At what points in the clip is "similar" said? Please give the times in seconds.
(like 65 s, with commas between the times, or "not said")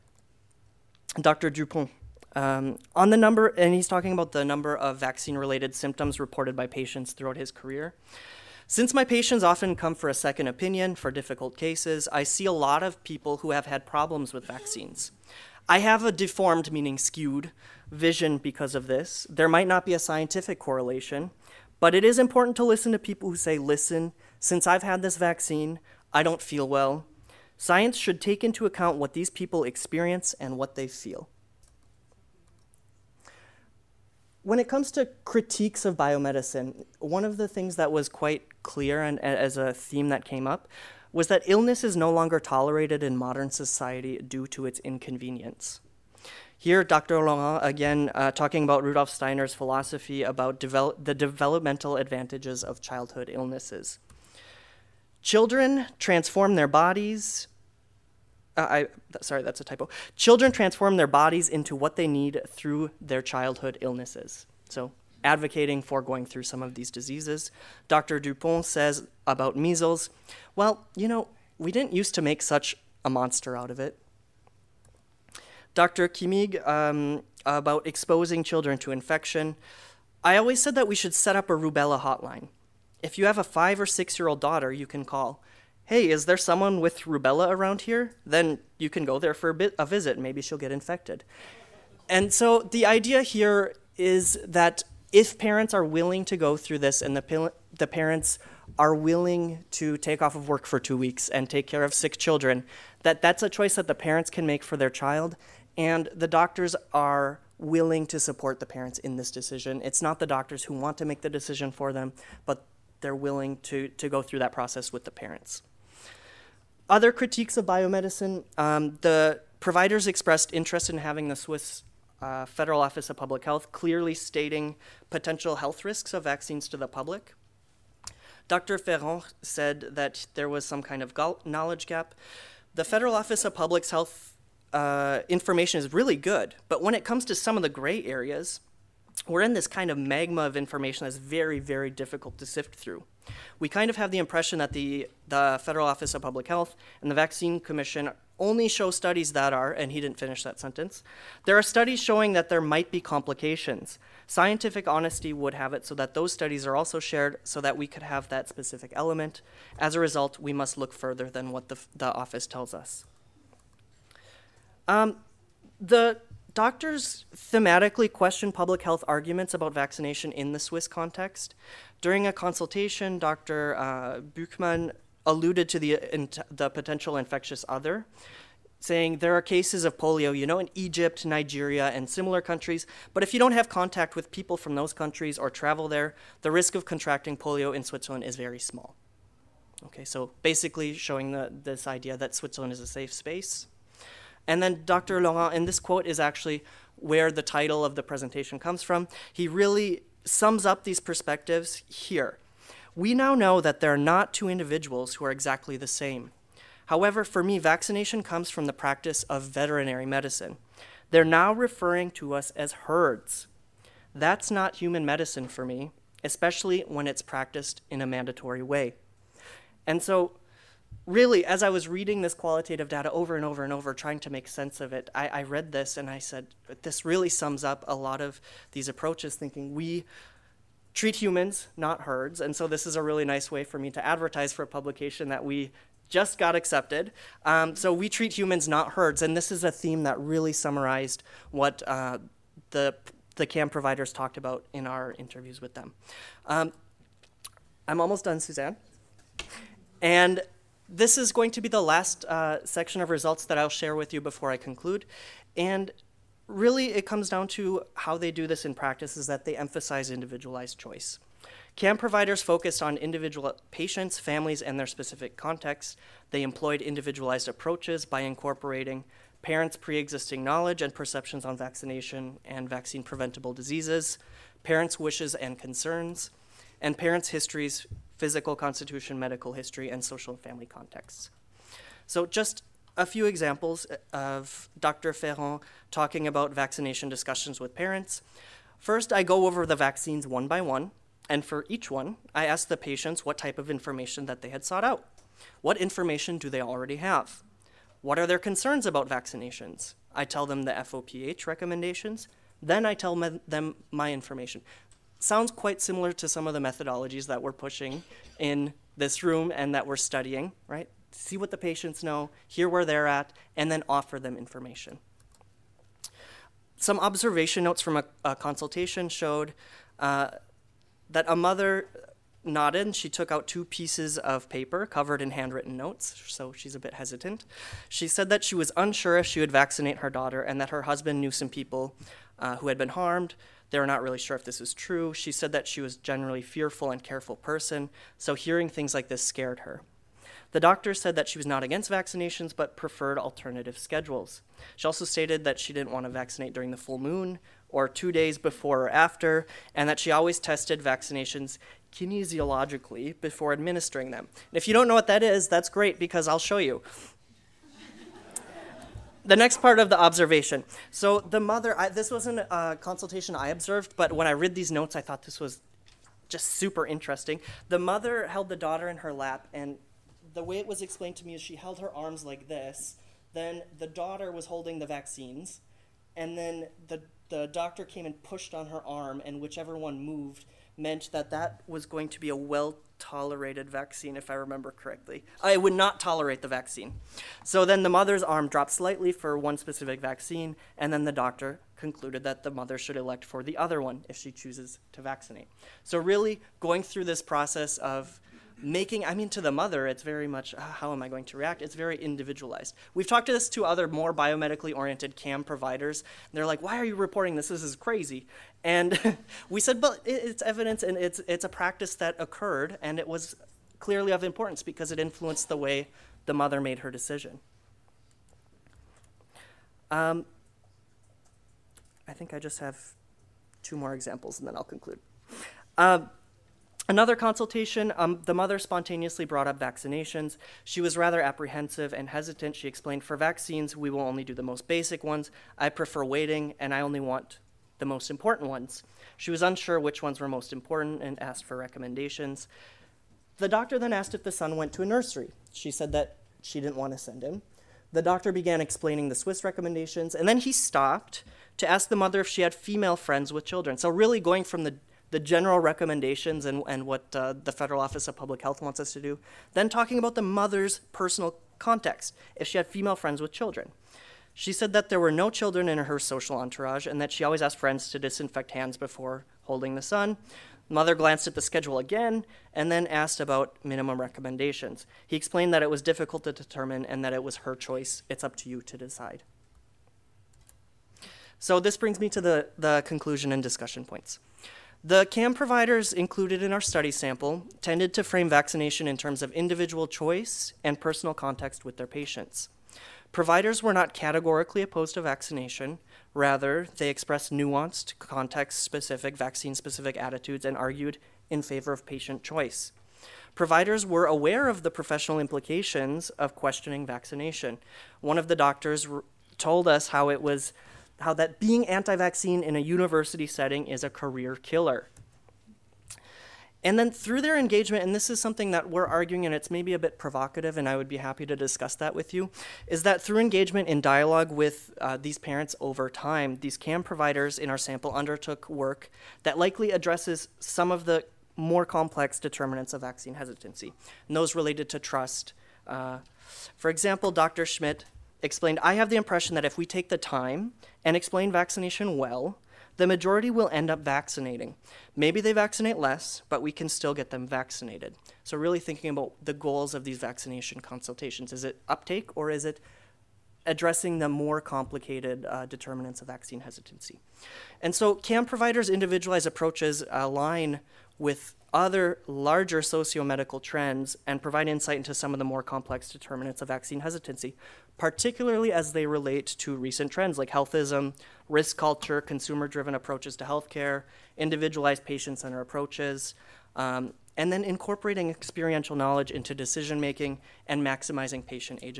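182 s, 305 s.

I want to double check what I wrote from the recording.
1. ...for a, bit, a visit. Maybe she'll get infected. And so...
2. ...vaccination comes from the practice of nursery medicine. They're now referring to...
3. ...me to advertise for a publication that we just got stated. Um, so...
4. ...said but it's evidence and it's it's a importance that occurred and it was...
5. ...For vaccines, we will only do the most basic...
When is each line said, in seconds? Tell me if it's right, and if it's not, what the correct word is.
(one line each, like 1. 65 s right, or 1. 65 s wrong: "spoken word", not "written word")
1. 89 s right
2. 207 s wrong: "veterinary", not "nursery"
3. 233 s wrong: "accepted", not "stated"
4. 409 s wrong: "practice", not "importance"
5. 433 s right.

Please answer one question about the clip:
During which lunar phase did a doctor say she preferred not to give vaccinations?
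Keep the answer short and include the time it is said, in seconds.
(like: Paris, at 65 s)
full moon, at 346 s.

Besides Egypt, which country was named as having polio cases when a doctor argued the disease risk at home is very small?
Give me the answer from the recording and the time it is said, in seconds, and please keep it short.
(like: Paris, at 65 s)
Nigeria, at 181 s.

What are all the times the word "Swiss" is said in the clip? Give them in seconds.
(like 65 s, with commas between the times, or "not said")
121 s, 170 s, 449 s.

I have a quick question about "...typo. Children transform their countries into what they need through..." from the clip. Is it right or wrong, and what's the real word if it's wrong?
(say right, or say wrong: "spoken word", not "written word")
wrong: "bodies", not "countries".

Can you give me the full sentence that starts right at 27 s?
Science should take into account what these people experience and what they feel.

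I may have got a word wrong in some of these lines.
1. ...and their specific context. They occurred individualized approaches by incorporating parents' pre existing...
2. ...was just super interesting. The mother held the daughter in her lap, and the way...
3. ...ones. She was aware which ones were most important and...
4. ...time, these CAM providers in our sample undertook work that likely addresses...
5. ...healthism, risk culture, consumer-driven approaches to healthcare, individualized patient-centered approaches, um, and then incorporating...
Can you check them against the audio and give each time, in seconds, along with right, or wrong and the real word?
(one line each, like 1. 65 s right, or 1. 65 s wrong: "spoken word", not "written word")
1. 264 s wrong: "employed", not "occurred"
2. 365 s right
3. 438 s wrong: "unsure", not "aware"
4. 525 s right
5. 570 s right.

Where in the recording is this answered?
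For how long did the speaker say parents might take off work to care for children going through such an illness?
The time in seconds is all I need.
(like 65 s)
100 s.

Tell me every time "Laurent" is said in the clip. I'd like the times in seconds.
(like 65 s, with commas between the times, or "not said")
47 s, 195 s.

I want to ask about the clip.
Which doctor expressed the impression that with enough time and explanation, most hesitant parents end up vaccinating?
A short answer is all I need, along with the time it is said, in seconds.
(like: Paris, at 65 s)
Dr. Schmidt, at 537 s.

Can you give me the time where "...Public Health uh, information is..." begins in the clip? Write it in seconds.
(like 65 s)
133 s.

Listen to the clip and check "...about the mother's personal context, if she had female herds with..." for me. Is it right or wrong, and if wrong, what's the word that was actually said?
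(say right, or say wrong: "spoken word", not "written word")
wrong: "friends", not "herds".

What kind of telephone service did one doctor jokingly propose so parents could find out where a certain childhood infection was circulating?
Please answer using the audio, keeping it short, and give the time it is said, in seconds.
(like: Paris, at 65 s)
rubella hotline, at 81 s.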